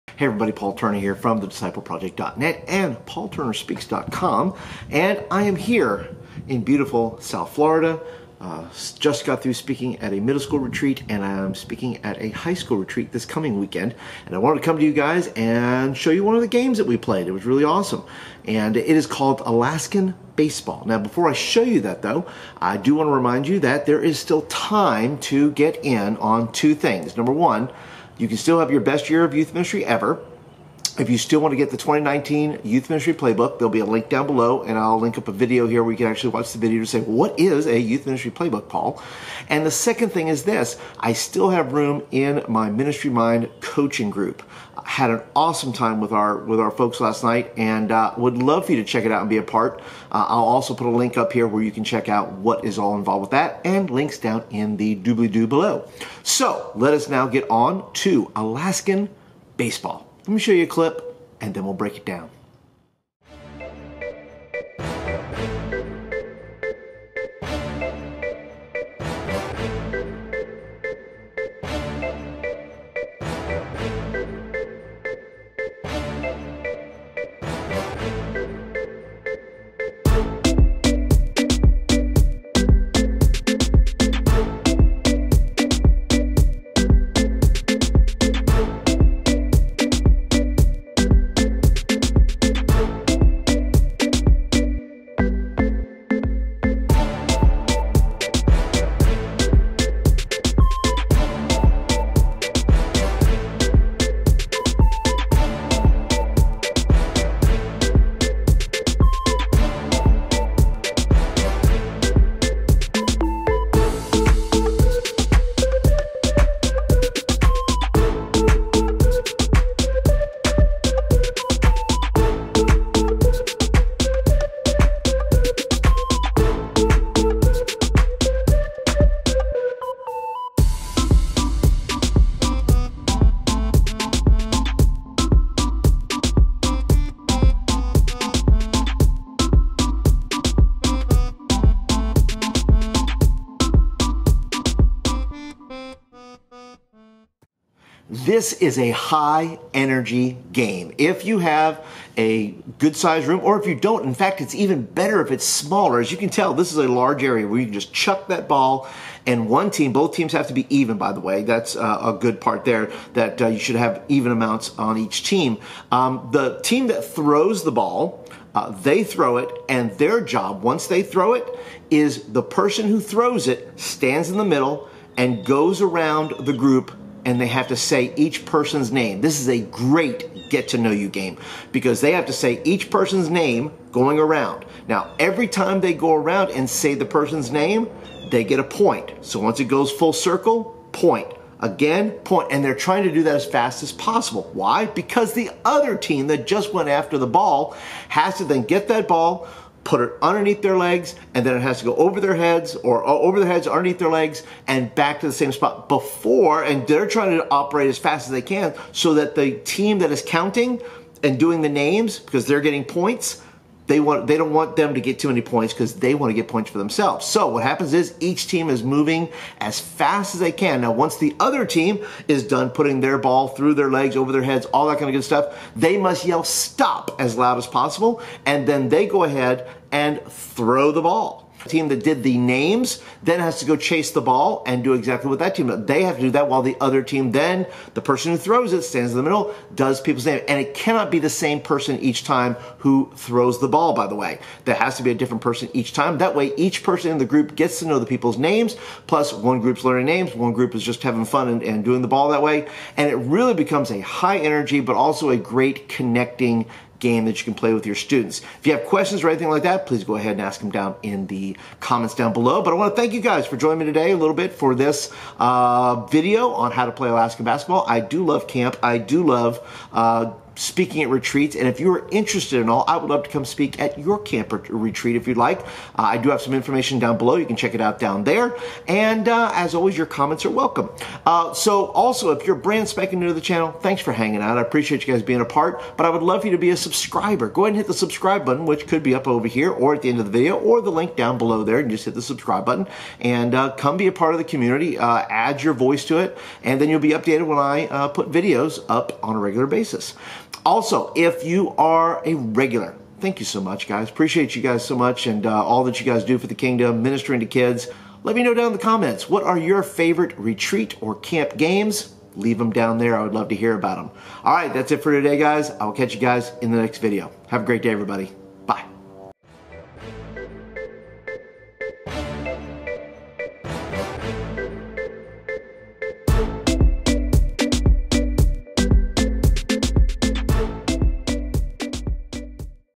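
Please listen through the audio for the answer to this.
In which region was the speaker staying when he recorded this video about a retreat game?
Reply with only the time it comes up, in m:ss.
0:07.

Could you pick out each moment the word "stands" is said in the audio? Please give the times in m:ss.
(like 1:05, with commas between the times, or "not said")
2:53, 3:58.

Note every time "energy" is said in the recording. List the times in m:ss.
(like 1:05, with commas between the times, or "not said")
2:29, 4:14.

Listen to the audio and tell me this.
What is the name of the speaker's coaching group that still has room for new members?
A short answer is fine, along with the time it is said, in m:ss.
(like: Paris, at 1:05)
Ministry Mind, at 0:42.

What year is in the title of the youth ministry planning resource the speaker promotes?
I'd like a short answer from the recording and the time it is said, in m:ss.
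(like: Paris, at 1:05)
2019, at 0:31.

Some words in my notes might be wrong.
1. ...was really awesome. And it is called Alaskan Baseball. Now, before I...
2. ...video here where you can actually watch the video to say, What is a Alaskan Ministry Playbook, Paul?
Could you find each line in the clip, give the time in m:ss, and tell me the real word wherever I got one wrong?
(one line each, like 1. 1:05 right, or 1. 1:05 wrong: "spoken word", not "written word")
1. 0:17 right
2. 0:35 wrong: "Youth", not "Alaskan".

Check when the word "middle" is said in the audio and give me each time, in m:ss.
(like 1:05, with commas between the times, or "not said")
0:10, 2:54, 3:59.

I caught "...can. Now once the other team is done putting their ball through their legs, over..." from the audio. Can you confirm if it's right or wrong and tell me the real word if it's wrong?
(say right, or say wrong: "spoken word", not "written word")
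right.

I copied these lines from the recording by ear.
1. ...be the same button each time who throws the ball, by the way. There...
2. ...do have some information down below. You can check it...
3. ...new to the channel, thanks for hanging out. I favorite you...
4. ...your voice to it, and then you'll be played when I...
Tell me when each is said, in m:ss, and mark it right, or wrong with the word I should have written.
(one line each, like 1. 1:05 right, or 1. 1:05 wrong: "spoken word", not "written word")
1. 4:01 wrong: "person", not "button"
2. 4:36 right
3. 4:43 wrong: "appreciate", not "favorite"
4. 4:55 wrong: "updated", not "played".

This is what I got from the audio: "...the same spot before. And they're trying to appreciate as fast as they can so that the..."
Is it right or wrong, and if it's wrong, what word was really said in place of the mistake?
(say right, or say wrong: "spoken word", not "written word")
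wrong: "operate", not "appreciate".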